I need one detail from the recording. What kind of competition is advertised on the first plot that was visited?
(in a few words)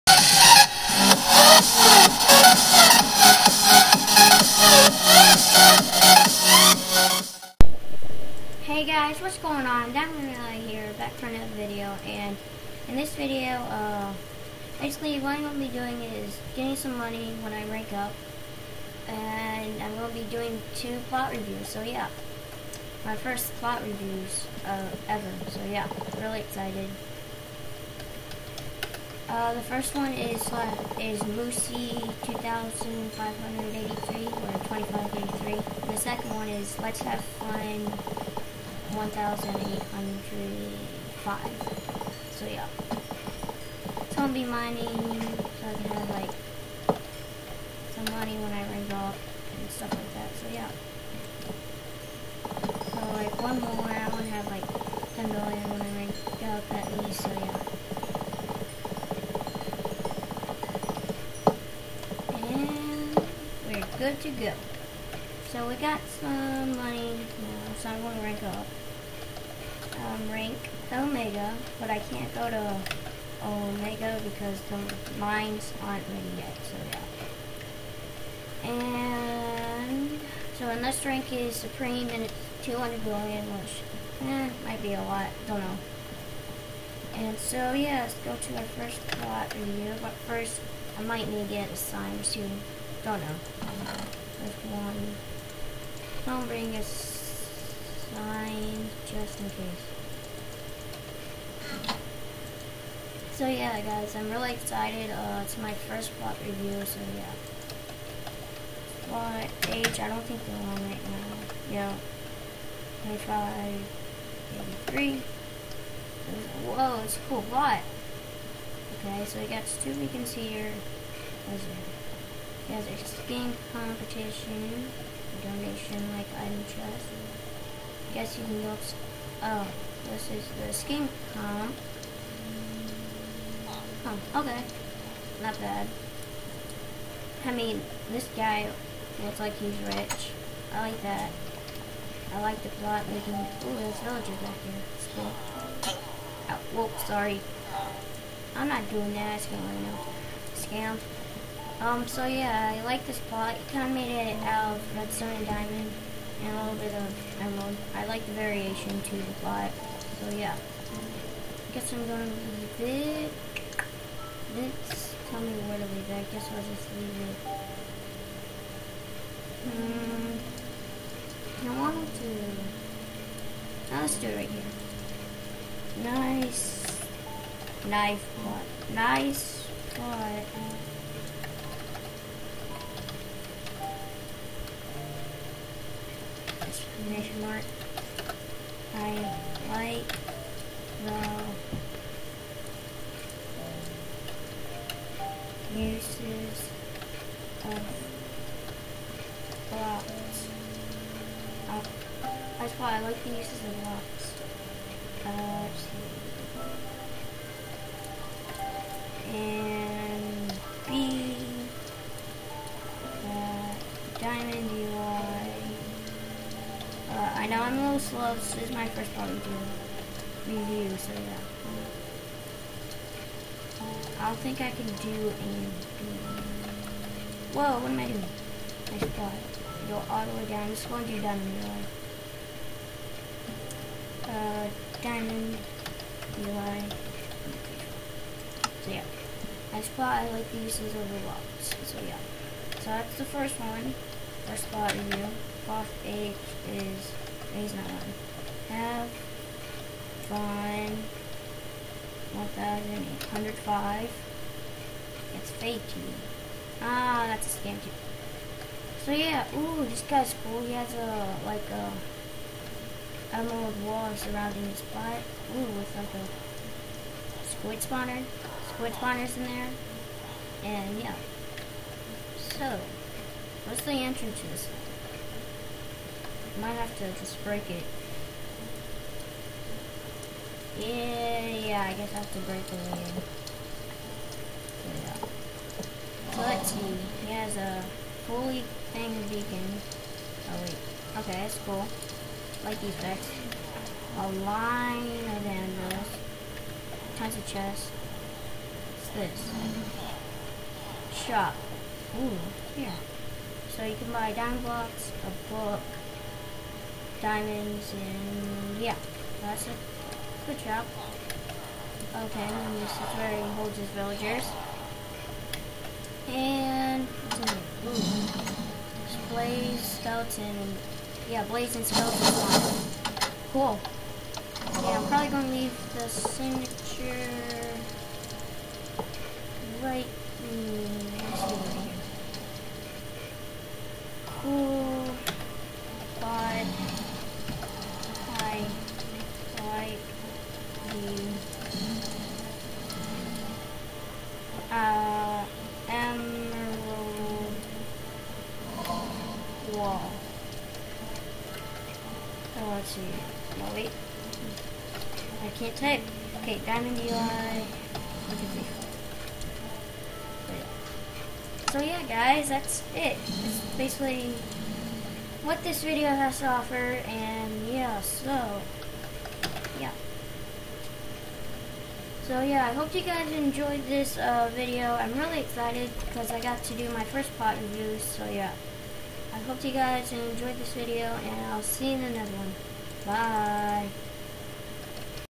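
skin competition.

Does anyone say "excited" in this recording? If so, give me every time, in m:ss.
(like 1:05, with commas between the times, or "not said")
0:26, 1:44, 6:15.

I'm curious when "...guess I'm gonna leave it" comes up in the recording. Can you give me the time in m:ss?
2:41.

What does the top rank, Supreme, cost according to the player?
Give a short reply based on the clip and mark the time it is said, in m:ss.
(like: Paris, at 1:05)
200 billion, at 1:22.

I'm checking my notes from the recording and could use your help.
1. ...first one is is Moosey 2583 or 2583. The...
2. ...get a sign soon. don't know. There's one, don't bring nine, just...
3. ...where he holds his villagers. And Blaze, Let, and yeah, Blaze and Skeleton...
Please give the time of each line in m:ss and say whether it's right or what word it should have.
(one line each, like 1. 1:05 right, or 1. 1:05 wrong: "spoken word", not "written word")
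1. 0:29 right
2. 1:31 right
3. 5:13 wrong: "Skeleton", not "Let".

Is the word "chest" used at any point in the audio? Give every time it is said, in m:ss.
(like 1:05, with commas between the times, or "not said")
2:06, 4:57.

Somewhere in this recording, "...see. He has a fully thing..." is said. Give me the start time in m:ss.
4:46.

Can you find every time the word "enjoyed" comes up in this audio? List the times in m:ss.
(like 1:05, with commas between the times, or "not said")
6:13, 6:20.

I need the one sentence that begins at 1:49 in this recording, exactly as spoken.
What age, I don't think they're on right now.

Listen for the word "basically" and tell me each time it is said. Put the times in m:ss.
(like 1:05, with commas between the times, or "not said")
0:14, 6:03.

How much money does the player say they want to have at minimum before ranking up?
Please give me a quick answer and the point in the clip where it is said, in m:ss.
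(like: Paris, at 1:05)
10 million, at 0:55.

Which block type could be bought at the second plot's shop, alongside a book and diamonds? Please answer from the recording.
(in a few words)
diamond blocks.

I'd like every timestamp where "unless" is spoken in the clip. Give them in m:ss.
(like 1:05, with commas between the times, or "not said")
1:20.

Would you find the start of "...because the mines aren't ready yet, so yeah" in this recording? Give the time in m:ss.
1:14.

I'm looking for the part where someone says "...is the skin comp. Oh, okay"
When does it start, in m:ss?
2:10.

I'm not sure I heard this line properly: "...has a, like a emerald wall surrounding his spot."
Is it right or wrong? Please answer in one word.
right.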